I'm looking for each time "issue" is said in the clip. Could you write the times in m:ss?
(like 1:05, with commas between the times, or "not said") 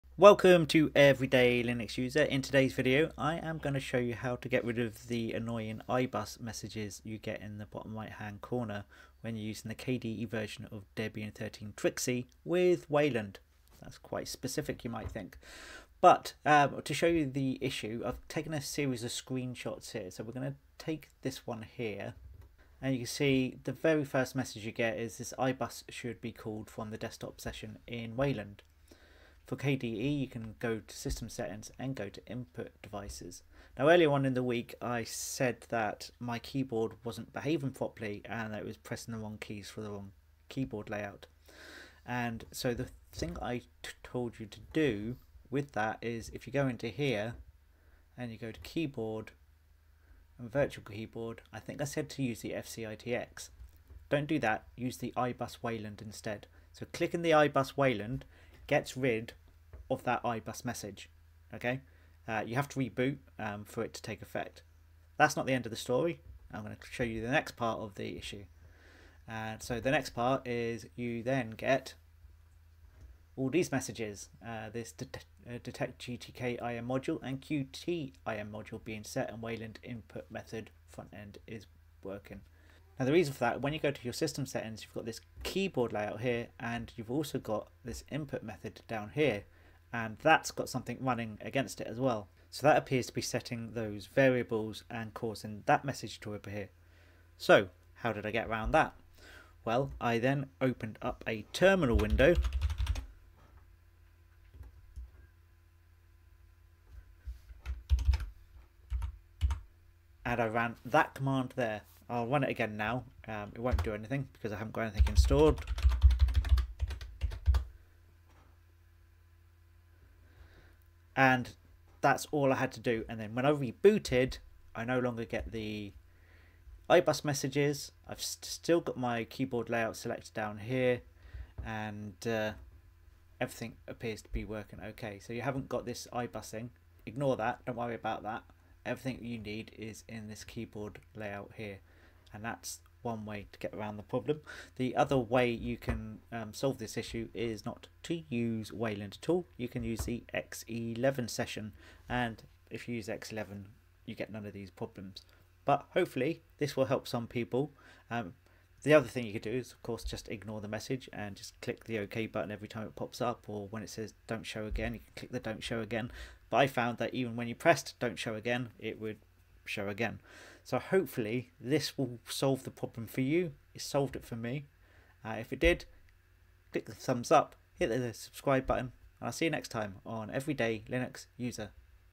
0:17, 1:08, 2:26.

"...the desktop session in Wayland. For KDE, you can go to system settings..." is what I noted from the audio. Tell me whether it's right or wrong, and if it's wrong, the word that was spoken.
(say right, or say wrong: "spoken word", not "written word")
right.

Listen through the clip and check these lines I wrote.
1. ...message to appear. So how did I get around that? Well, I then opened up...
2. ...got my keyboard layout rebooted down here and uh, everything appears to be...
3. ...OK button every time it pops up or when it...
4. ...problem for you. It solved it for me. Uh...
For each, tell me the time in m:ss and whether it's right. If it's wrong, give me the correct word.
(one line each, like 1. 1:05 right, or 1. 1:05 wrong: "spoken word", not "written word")
1. 1:35 right
2. 2:08 wrong: "selected", not "rebooted"
3. 2:41 right
4. 2:52 right.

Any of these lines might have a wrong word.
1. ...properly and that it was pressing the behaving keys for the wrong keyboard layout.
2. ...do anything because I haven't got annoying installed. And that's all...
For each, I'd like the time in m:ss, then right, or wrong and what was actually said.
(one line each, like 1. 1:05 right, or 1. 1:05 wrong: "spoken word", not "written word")
1. 0:37 wrong: "wrong", not "behaving"
2. 1:53 wrong: "anything", not "annoying".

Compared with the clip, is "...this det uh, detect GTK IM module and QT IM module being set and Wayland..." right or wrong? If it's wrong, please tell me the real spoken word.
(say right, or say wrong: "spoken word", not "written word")
right.